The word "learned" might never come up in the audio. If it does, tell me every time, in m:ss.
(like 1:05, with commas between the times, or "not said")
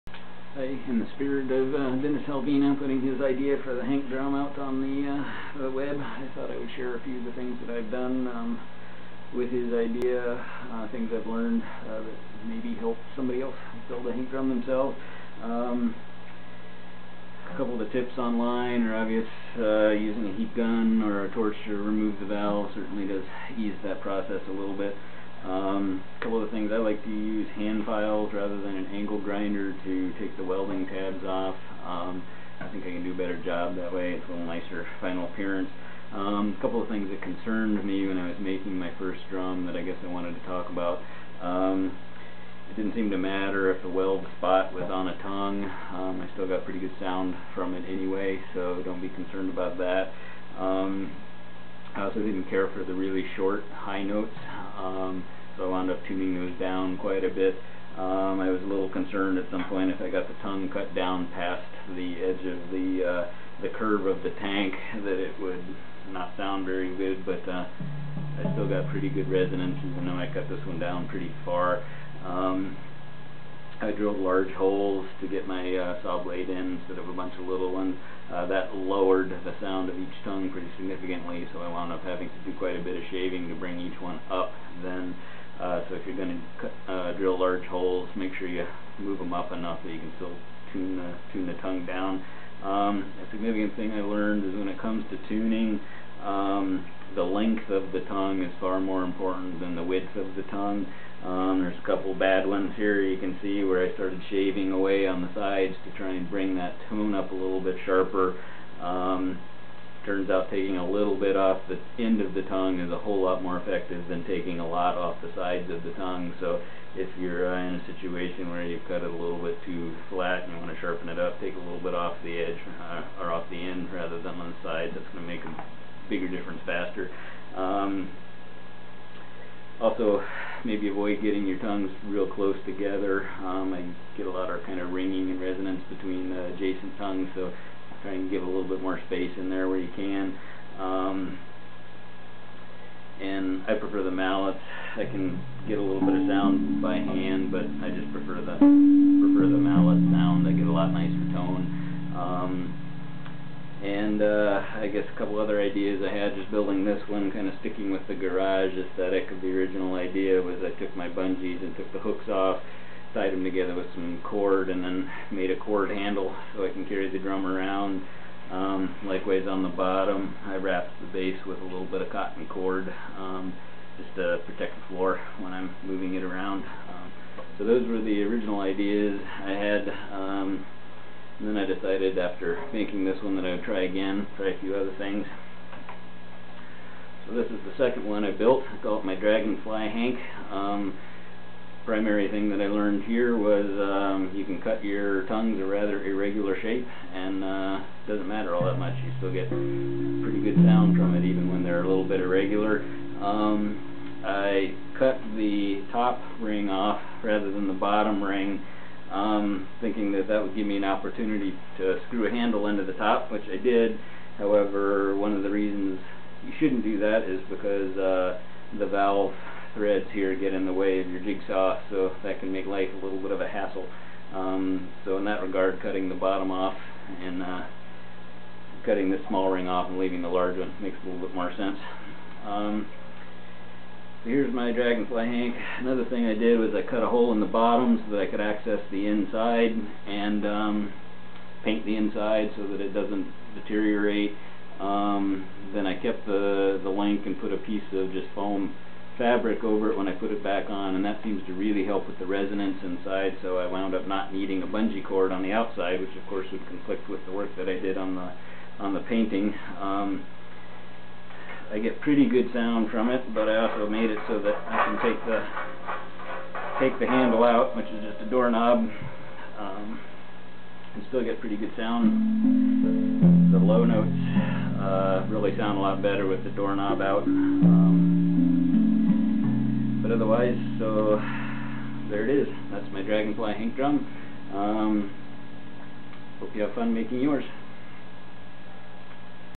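0:11, 1:34, 3:12.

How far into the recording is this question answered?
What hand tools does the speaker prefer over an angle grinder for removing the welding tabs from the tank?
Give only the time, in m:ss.
0:27.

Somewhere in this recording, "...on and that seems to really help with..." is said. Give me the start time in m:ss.
4:10.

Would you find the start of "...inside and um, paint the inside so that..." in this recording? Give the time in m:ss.
3:59.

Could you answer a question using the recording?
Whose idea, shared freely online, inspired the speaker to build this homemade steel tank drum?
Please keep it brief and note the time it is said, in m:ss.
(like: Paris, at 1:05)
Dennis Havlena, at 0:02.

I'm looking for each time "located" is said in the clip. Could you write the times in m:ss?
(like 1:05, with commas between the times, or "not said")
not said.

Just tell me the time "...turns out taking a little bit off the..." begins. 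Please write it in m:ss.
1:50.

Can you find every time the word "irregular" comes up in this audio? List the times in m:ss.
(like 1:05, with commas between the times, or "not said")
3:16, 3:22.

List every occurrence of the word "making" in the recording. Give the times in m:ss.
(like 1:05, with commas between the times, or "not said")
0:38, 3:02, 4:46.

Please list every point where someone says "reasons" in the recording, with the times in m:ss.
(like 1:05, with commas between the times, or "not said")
3:35.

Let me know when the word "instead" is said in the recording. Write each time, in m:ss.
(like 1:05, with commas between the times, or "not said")
1:16.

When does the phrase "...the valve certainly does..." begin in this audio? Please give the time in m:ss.
0:22.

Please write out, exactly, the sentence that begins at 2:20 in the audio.
Um, and I prefer the mallets.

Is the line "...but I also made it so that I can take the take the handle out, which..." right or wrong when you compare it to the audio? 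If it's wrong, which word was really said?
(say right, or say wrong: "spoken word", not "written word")
right.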